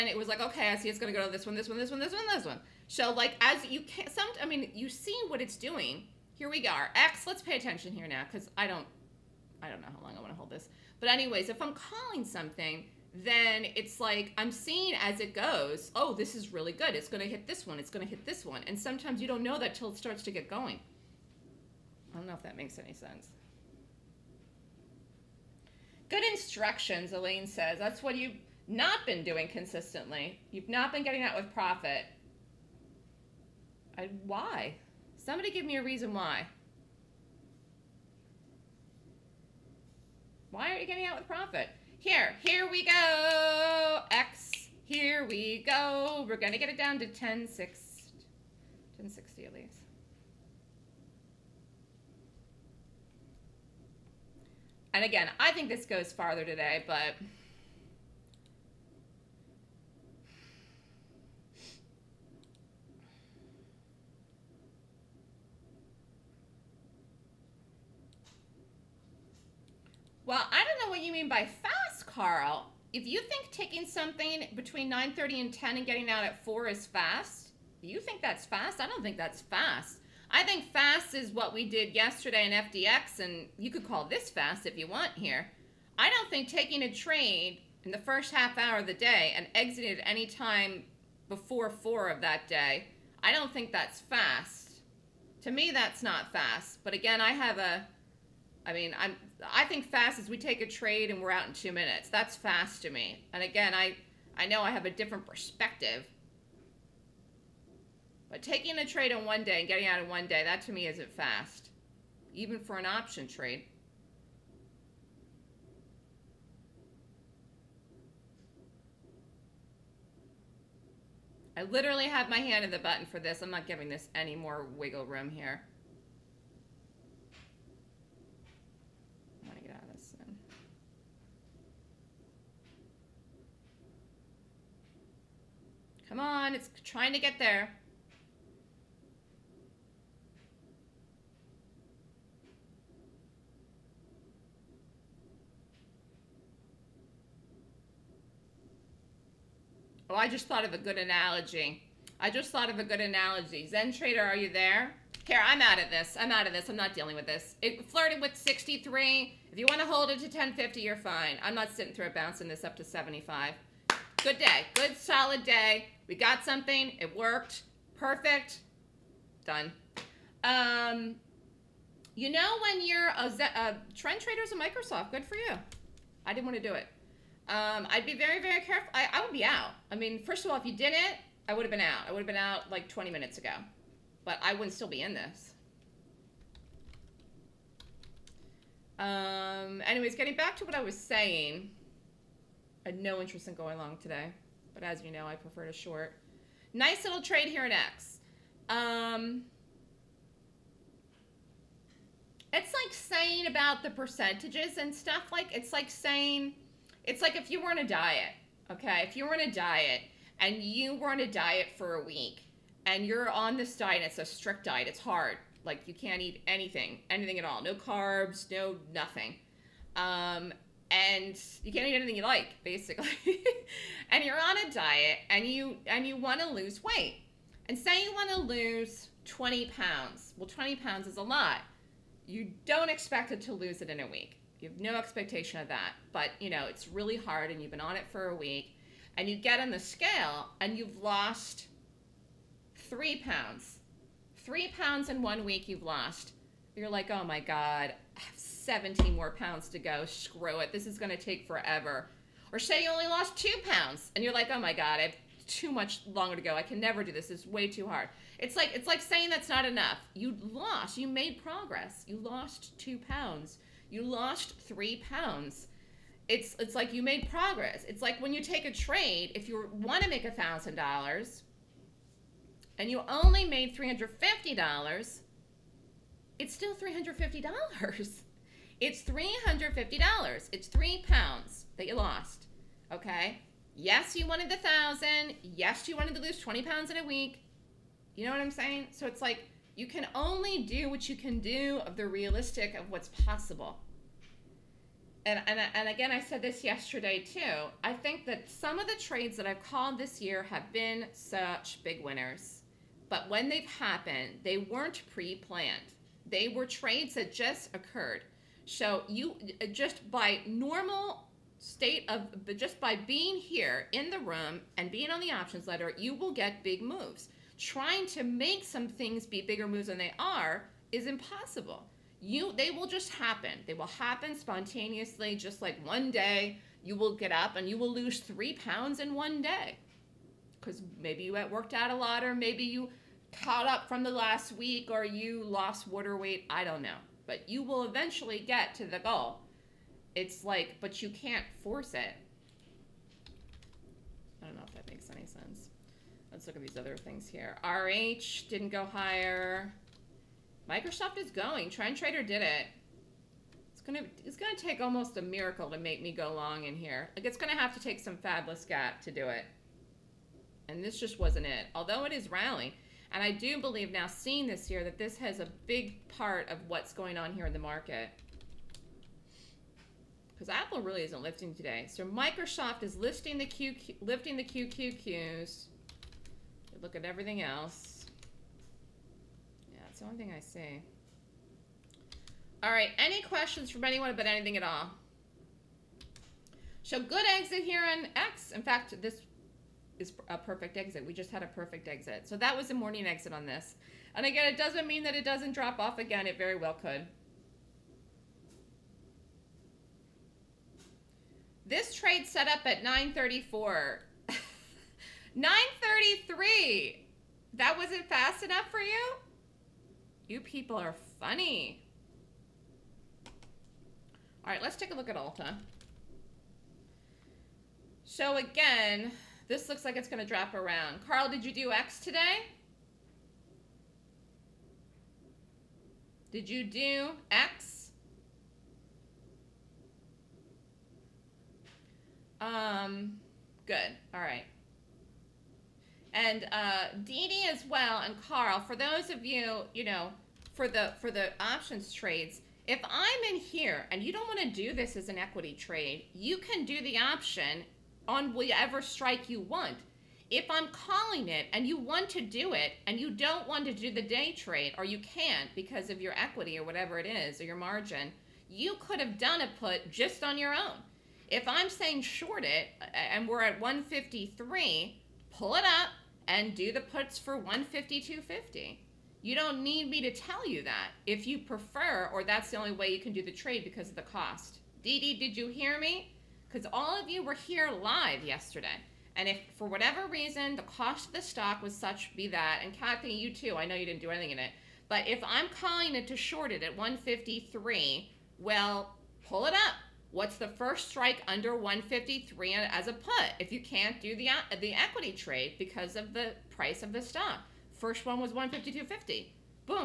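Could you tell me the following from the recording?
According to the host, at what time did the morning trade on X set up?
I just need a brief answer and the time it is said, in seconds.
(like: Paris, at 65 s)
9:34, at 402 s.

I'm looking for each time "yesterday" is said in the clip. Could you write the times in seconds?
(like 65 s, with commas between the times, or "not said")
81 s, 296 s, 478 s.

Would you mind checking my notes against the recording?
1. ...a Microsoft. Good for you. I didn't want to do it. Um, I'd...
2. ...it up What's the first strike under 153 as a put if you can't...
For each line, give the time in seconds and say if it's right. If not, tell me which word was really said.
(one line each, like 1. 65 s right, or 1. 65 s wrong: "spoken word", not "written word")
1. 174 s right
2. 489 s right.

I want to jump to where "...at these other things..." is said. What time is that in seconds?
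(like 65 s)
346 s.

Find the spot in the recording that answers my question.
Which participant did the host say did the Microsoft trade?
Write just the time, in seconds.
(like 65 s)
351 s.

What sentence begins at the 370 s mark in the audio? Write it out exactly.
Because Apple really isn't lifting today.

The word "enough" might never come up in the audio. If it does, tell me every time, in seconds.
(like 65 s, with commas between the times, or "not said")
259 s, 408 s.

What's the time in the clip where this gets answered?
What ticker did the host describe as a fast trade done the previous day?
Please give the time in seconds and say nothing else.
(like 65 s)
82 s.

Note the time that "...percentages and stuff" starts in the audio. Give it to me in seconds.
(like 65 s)
203 s.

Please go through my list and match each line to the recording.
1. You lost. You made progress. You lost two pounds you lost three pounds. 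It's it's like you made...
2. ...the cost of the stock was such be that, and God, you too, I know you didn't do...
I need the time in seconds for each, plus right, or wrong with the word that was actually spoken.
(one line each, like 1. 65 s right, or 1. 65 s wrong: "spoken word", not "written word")
1. 260 s right
2. 480 s wrong: "Kathy", not "God".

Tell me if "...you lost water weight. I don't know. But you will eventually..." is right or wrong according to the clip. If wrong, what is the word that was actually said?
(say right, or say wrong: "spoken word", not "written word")
right.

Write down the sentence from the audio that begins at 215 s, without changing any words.
Like you can't eat anything, anything at all.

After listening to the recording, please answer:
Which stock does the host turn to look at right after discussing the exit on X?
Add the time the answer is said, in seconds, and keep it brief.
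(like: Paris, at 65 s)
Ulta, at 415 s.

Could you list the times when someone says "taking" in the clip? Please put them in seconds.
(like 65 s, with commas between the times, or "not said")
73 s, 86 s, 108 s.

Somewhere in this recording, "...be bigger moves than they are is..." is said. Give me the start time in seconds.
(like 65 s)
319 s.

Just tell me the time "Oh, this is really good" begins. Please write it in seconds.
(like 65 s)
15 s.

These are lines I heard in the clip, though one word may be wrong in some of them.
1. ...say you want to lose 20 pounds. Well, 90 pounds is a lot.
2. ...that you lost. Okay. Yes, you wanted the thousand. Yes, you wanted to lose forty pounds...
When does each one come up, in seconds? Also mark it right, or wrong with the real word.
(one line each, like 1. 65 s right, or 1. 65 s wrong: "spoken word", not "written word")
1. 227 s wrong: "20", not "90"
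2. 281 s wrong: "twenty", not "forty".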